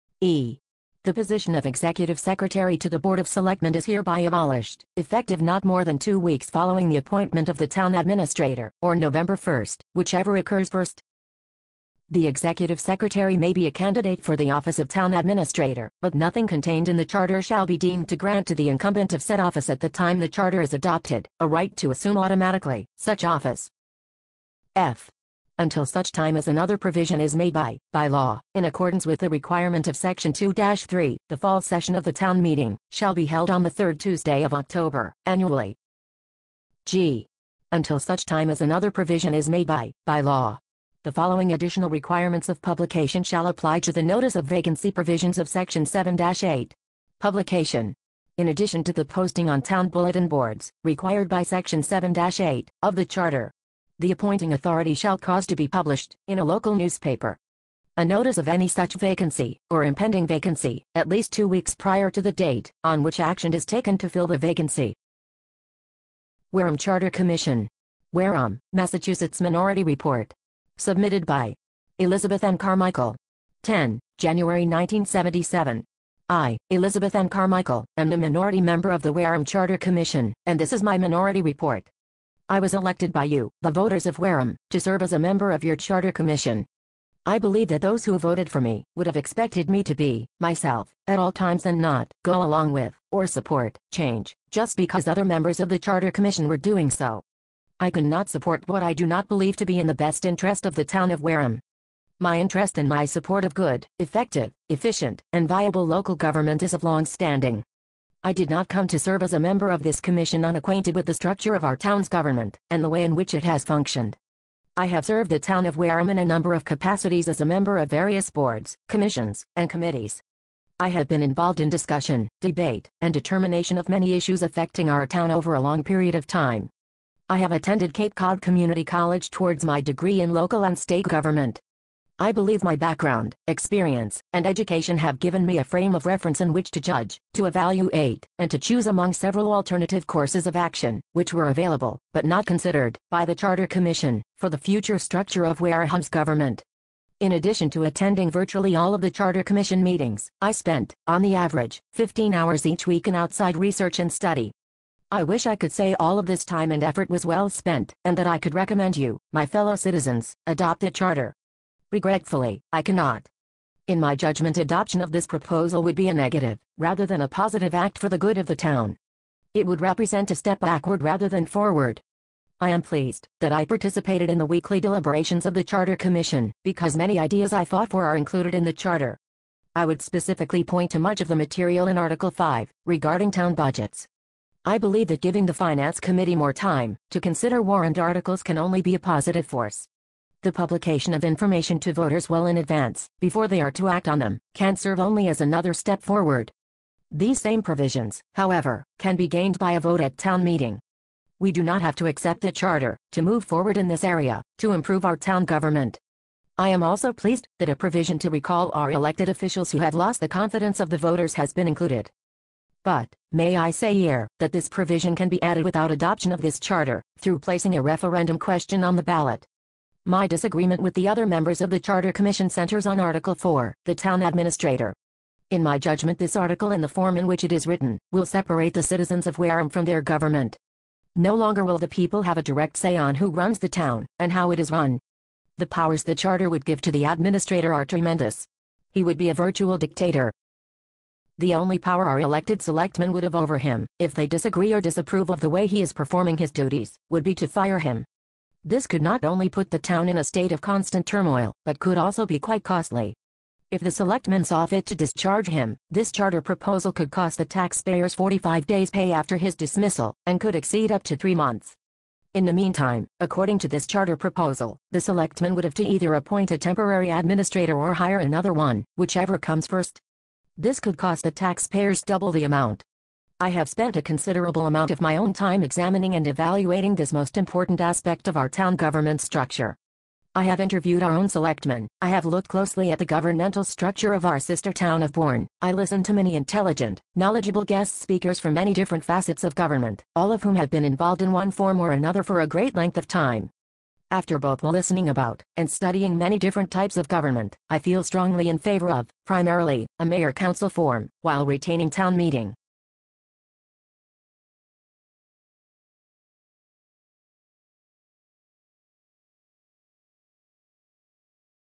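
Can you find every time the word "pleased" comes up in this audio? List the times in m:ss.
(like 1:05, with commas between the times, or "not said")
2:52, 3:27.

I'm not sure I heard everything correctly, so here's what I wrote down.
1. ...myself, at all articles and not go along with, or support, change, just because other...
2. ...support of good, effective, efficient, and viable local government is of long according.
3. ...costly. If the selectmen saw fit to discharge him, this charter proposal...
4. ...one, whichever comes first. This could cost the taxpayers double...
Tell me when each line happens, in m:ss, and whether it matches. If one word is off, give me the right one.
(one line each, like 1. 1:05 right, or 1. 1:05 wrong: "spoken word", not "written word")
1. 1:30 wrong: "times", not "articles"
2. 1:43 wrong: "standing", not "according"
3. 4:12 right
4. 4:28 right.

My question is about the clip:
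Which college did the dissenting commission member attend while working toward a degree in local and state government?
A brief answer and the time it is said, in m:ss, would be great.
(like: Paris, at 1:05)
Cape Cod Community College, at 2:07.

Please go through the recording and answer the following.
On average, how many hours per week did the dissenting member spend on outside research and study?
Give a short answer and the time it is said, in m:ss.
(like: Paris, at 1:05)
15, at 2:31.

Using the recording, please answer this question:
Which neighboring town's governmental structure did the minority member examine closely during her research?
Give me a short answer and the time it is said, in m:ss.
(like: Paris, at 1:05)
Bourne, at 4:45.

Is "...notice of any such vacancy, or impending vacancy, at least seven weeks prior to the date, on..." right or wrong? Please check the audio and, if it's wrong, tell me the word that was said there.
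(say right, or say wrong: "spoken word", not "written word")
wrong: "two", not "seven".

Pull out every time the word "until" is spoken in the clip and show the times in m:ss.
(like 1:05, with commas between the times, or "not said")
0:25, 0:37.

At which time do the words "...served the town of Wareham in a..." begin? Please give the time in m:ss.
1:55.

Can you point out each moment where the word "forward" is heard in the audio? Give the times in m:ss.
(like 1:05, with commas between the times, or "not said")
2:51, 3:16, 3:23.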